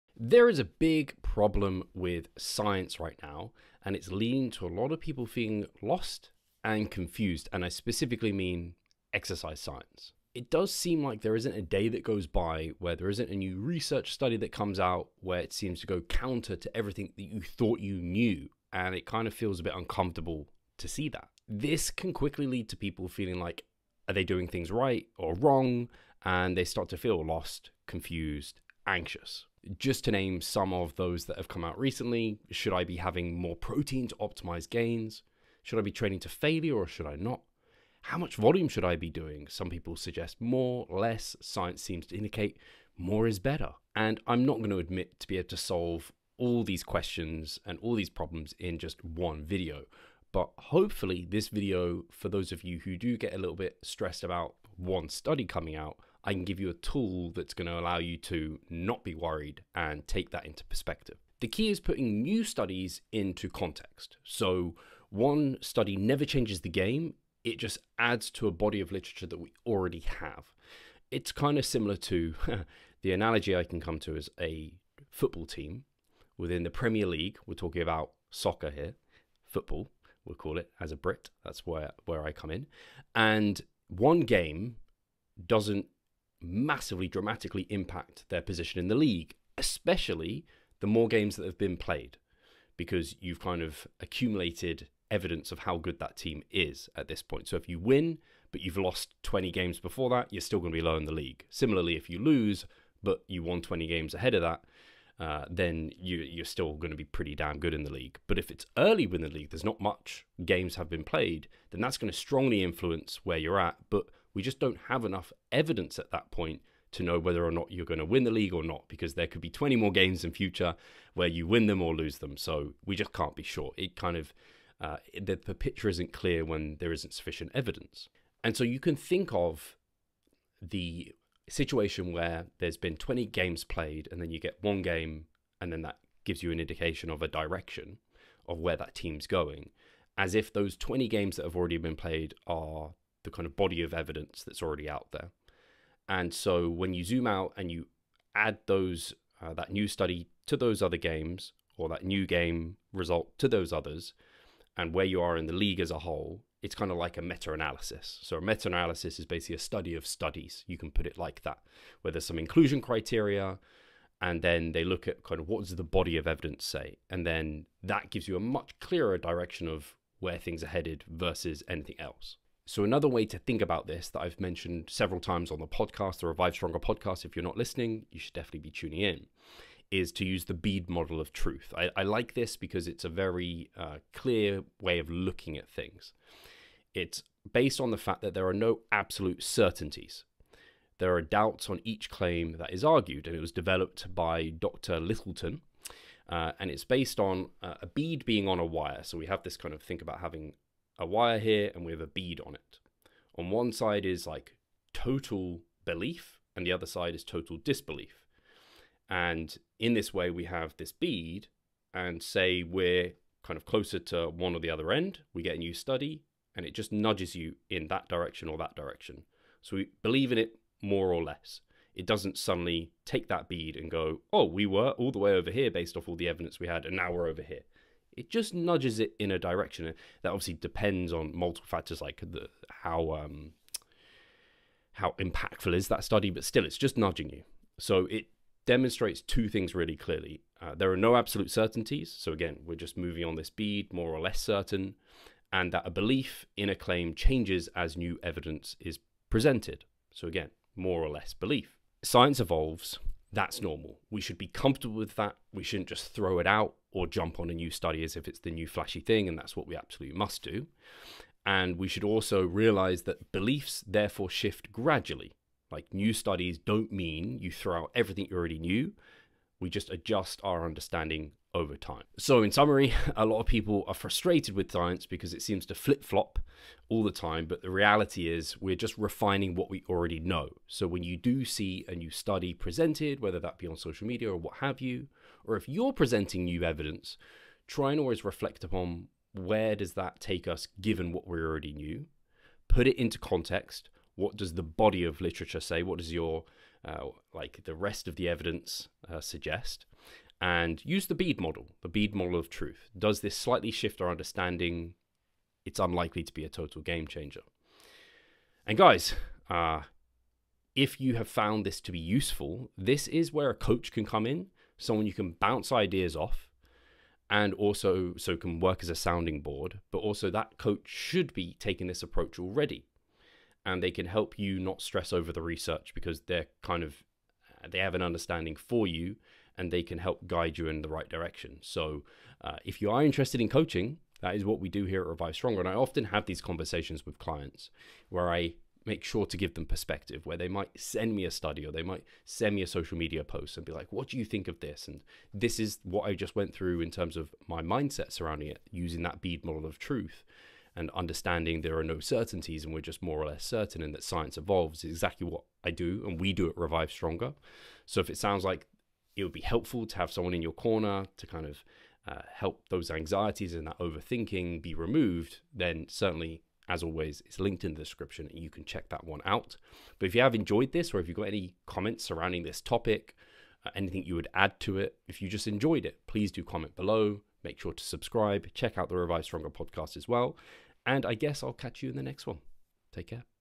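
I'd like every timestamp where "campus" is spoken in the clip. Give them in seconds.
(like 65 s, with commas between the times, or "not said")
not said.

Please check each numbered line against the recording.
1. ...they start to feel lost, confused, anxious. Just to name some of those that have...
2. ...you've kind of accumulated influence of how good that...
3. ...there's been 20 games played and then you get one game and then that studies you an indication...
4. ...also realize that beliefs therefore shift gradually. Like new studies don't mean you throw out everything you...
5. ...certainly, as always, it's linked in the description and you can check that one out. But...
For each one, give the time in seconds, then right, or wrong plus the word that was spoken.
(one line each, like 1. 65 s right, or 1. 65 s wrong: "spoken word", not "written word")
1. 26 s right
2. 93 s wrong: "evidence", not "influence"
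3. 132 s wrong: "gives", not "studies"
4. 262 s right
5. 365 s right.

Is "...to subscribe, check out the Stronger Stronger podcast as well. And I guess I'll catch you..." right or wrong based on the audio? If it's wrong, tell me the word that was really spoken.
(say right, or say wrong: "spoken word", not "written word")
wrong: "Revive", not "Stronger".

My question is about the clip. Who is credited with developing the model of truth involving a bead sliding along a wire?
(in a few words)
Dr. Lyttleton.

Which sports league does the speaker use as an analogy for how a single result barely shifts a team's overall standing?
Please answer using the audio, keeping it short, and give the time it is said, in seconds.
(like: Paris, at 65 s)
Premier League, at 76 s.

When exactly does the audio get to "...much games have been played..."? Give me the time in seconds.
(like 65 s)
109 s.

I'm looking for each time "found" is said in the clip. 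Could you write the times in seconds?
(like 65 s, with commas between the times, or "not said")
311 s.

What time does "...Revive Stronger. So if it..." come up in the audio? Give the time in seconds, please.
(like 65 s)
356 s.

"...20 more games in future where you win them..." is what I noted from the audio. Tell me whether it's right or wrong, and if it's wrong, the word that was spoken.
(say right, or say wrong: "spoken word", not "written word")
right.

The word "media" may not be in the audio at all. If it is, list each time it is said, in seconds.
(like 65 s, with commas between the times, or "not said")
284 s, 342 s.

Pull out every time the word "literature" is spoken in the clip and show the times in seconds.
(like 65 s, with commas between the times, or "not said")
68 s, 295 s.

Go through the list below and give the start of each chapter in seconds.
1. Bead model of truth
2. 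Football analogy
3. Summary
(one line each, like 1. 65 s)
1. 180 s
2. 60 s
3. 270 s.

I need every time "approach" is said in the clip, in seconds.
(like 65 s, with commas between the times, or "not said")
322 s.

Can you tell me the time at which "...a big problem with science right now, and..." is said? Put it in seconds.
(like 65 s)
0 s.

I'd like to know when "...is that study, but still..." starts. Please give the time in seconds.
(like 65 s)
235 s.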